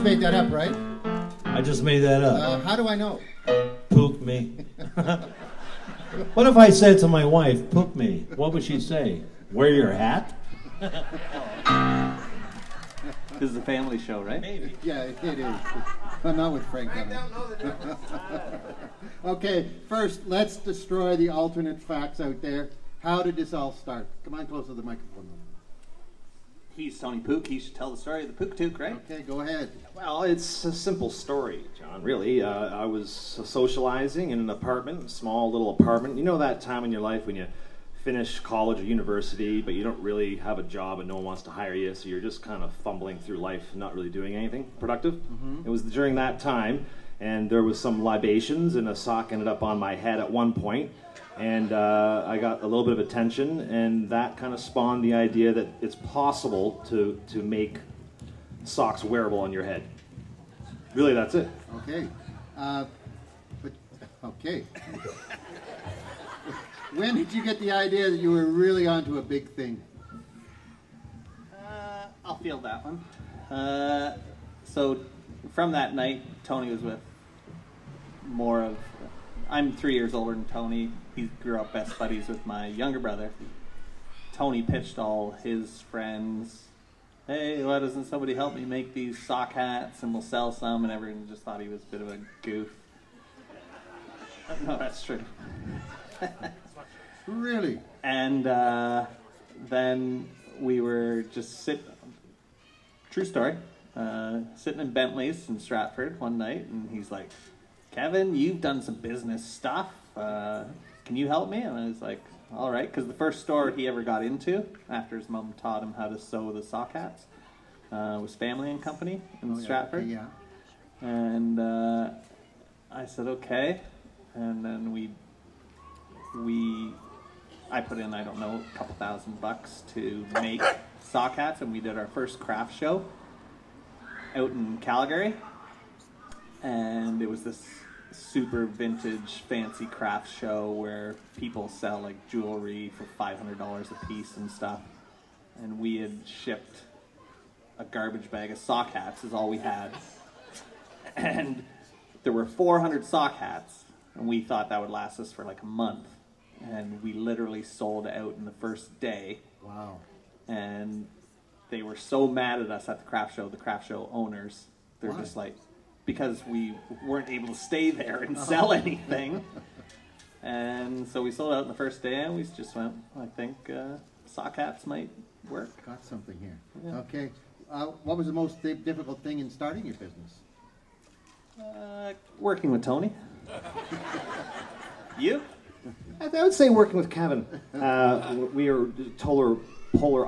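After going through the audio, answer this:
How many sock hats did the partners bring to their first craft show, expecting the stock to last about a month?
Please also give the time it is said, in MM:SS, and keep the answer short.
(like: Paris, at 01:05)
400, at 02:32.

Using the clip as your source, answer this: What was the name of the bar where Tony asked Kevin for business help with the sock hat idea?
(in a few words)
Bentley's.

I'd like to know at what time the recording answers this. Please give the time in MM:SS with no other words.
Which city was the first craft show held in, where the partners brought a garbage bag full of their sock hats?
02:14.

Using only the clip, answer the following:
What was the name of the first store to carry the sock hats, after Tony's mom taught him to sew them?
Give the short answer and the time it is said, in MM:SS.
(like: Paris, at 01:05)
Family and Company, at 01:58.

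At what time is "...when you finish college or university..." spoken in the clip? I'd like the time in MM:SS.
00:37.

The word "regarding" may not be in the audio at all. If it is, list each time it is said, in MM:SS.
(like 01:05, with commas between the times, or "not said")
not said.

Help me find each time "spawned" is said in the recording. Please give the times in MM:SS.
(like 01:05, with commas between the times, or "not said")
00:54.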